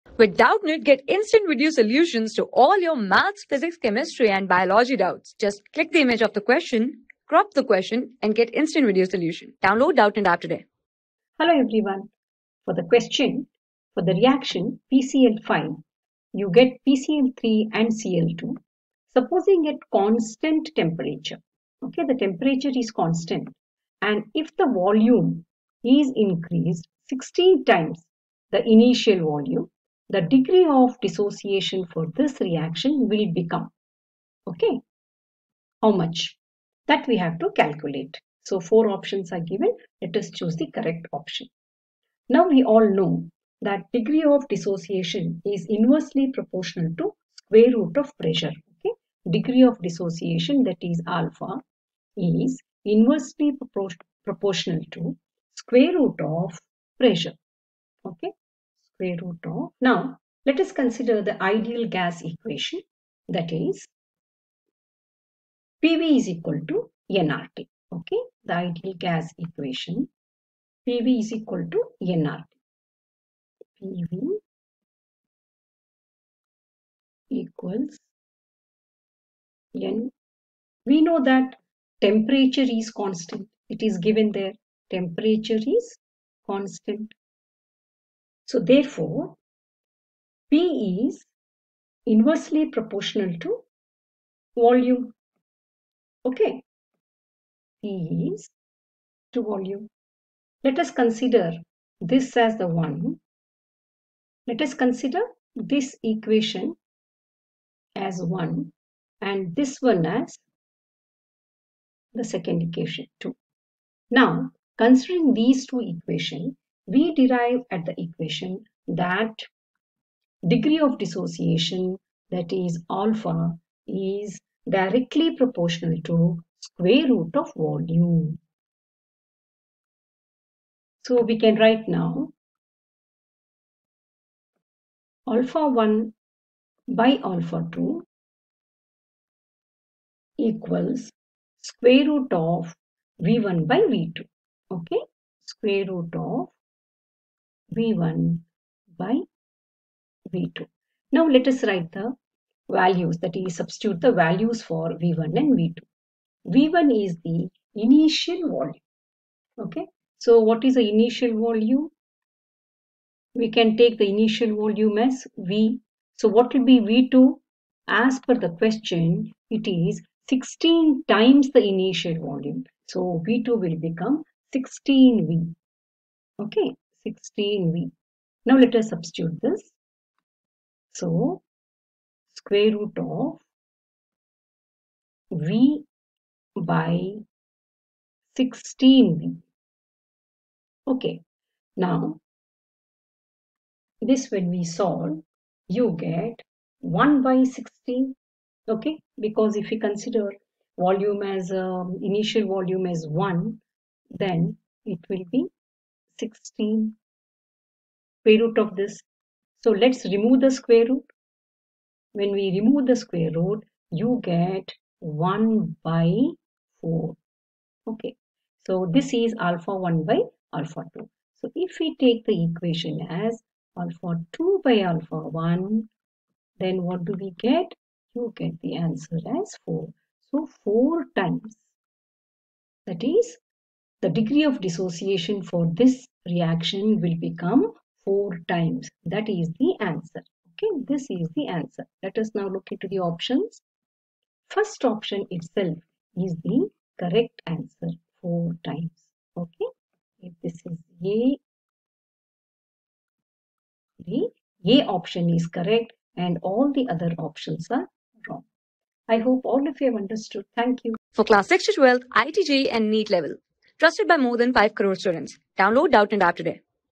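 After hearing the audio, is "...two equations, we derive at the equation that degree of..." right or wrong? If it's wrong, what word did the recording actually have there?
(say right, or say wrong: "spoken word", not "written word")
right.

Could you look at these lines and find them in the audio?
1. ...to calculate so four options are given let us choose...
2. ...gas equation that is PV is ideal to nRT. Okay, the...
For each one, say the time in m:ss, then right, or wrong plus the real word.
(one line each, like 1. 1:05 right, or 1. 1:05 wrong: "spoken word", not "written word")
1. 0:37 right
2. 1:01 wrong: "equal", not "ideal".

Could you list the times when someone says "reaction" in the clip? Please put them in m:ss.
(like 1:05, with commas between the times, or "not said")
0:14, 0:32, 3:56.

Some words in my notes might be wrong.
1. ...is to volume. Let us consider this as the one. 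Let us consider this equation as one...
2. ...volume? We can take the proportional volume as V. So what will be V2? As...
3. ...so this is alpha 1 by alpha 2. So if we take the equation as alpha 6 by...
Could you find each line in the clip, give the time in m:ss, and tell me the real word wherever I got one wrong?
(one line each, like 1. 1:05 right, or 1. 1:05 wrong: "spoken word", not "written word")
1. 1:38 right
2. 2:41 wrong: "initial", not "proportional"
3. 3:38 wrong: "2", not "6".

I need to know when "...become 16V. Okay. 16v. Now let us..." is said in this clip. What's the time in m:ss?
2:53.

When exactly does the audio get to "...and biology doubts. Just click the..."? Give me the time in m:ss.
0:04.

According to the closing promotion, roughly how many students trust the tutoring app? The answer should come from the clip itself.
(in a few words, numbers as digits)
More than 5 crore.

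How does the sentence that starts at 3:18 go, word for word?
Okay, because if we consider volume as um, initial volume as 1, then it will be 16 square root of this.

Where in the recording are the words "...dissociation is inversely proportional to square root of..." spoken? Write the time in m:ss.
0:44.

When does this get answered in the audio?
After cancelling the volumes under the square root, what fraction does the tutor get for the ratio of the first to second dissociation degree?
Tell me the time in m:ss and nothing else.
3:34.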